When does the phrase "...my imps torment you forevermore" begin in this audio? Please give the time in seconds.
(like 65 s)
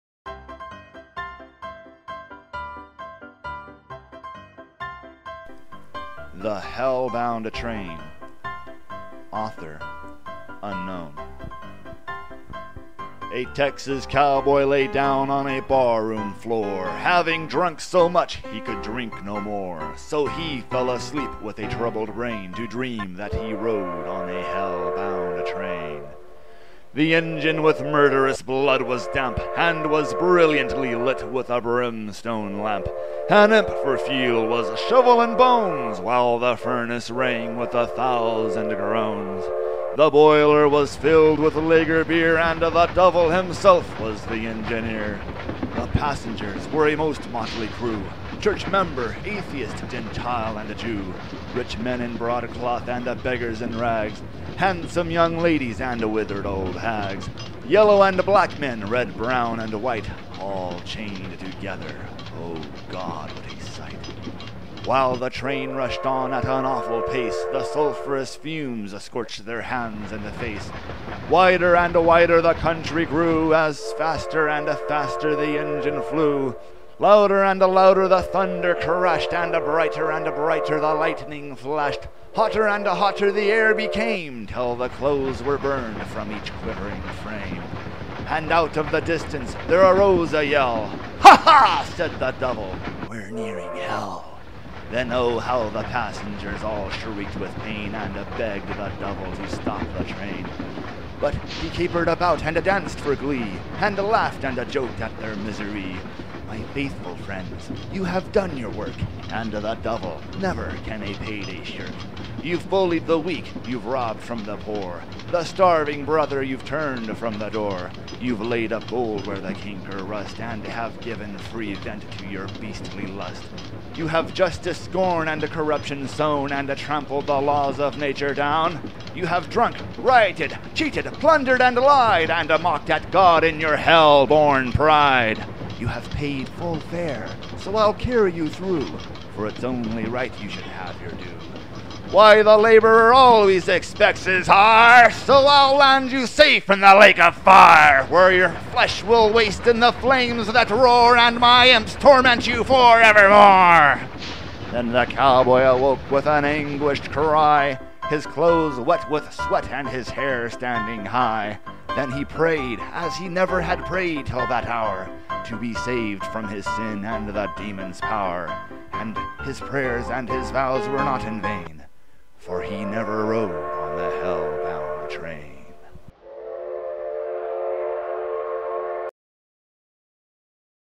151 s.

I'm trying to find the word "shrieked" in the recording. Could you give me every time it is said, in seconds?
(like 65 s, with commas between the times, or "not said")
96 s.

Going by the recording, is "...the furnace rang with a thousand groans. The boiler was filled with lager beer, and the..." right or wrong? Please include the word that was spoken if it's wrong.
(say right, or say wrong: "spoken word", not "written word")
right.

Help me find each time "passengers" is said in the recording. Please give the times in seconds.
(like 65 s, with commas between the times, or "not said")
45 s, 95 s.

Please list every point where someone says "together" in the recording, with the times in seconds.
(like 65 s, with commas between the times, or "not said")
61 s.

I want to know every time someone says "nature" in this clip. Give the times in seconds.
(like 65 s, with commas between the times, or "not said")
127 s.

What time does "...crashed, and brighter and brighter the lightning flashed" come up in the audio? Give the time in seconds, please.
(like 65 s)
78 s.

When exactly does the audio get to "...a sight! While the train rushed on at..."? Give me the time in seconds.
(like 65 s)
63 s.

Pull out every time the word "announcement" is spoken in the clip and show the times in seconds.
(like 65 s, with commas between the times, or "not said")
not said.